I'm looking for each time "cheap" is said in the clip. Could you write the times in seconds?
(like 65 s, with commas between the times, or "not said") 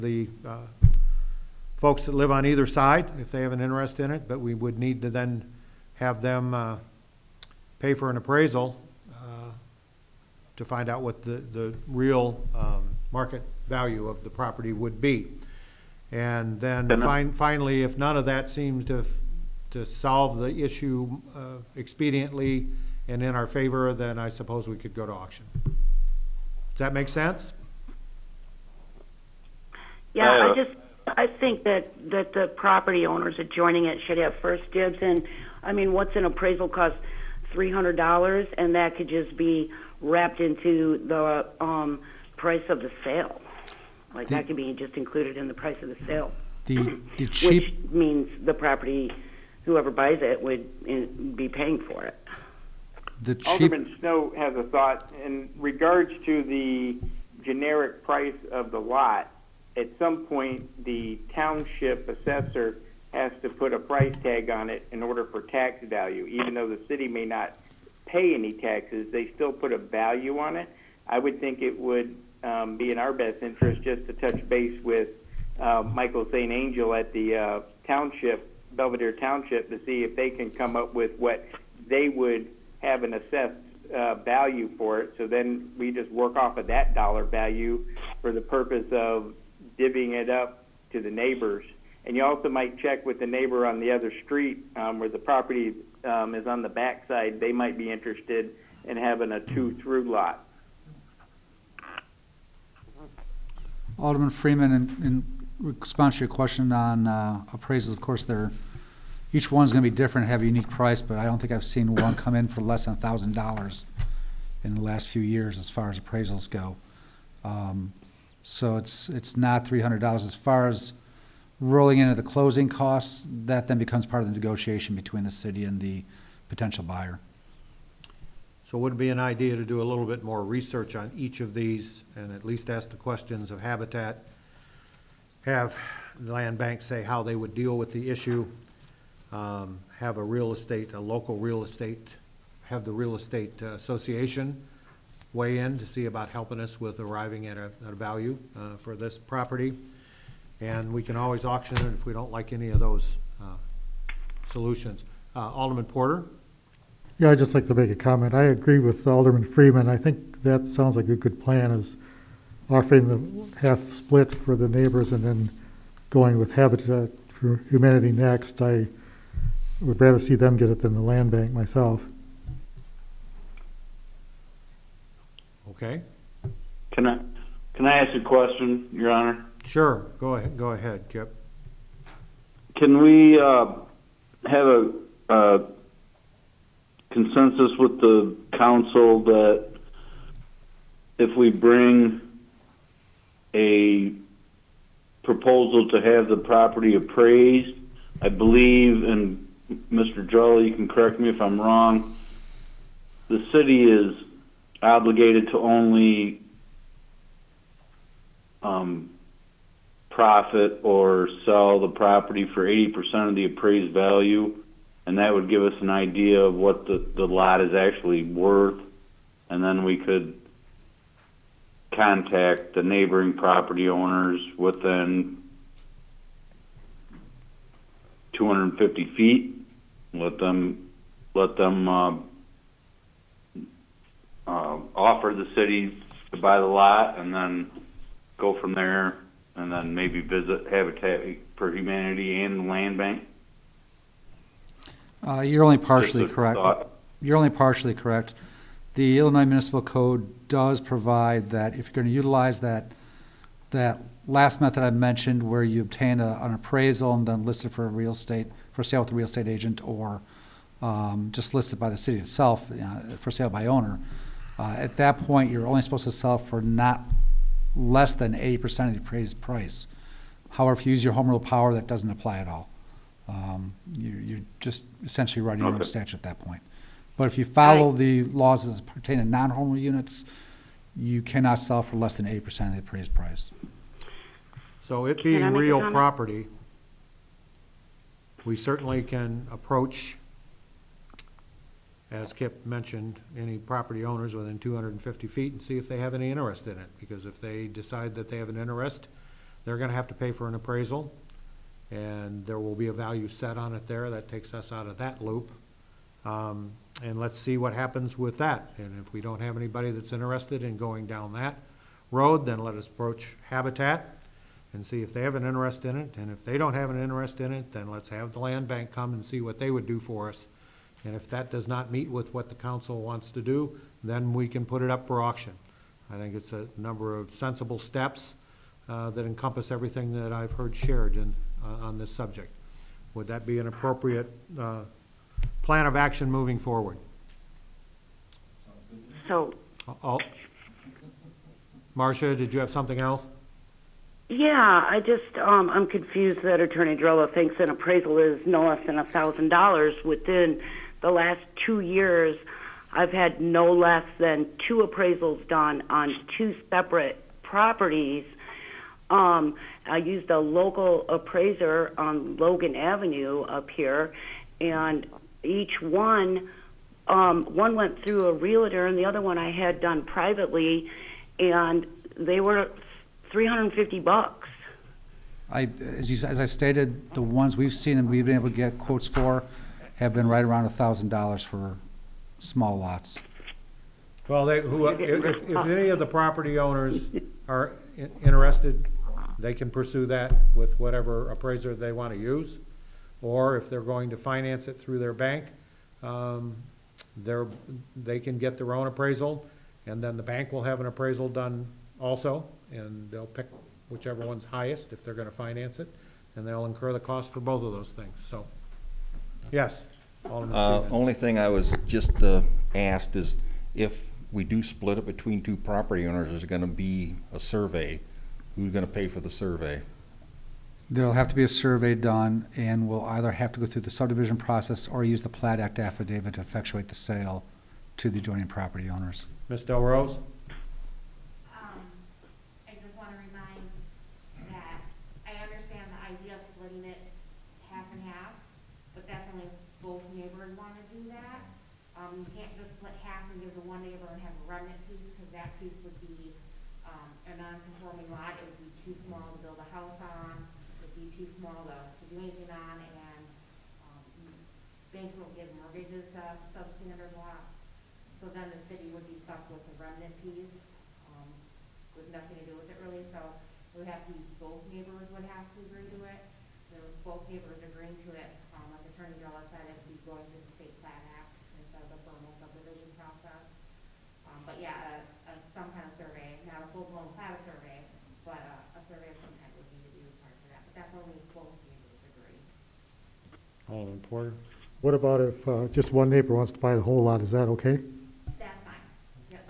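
47 s, 53 s.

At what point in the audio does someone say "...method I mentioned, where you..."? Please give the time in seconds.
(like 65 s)
254 s.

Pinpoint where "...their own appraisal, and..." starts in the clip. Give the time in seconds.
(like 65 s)
398 s.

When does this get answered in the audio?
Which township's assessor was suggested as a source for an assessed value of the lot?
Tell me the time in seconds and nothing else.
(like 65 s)
78 s.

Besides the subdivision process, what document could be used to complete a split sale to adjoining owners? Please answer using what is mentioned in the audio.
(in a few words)
plat act affidavit.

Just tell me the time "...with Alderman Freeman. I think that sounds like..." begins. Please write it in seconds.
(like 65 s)
158 s.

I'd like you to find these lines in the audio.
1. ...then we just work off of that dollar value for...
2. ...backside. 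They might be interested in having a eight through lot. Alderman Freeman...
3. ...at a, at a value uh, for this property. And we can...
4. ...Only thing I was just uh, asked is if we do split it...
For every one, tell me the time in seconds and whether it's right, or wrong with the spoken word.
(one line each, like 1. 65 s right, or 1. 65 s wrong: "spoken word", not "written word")
1. 85 s right
2. 96 s wrong: "two", not "eight"
3. 147 s right
4. 410 s right.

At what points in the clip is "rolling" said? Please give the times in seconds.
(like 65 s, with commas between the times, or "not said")
121 s.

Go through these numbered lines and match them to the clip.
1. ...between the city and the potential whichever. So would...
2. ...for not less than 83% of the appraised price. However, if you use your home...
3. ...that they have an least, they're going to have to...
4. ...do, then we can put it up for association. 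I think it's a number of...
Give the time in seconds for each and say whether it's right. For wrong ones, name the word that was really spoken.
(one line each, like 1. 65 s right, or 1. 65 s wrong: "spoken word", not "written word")
1. 124 s wrong: "buyer", not "whichever"
2. 266 s wrong: "80", not "83"
3. 298 s wrong: "interest", not "least"
4. 323 s wrong: "auction", not "association".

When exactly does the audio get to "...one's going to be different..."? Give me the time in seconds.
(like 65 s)
109 s.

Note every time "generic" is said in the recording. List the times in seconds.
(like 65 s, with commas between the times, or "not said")
57 s.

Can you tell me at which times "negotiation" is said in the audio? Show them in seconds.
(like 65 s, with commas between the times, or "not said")
124 s.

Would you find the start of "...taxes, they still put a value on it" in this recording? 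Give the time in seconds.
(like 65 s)
68 s.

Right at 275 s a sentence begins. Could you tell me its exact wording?
your own statute at that point.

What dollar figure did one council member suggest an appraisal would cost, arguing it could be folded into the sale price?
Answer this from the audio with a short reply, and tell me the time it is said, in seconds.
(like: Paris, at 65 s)
$300, at 37 s.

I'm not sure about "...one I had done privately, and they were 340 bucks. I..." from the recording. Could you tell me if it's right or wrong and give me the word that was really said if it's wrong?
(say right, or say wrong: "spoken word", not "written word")
wrong: "350", not "340".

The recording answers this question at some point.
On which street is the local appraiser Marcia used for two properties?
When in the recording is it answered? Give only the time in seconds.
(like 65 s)
362 s.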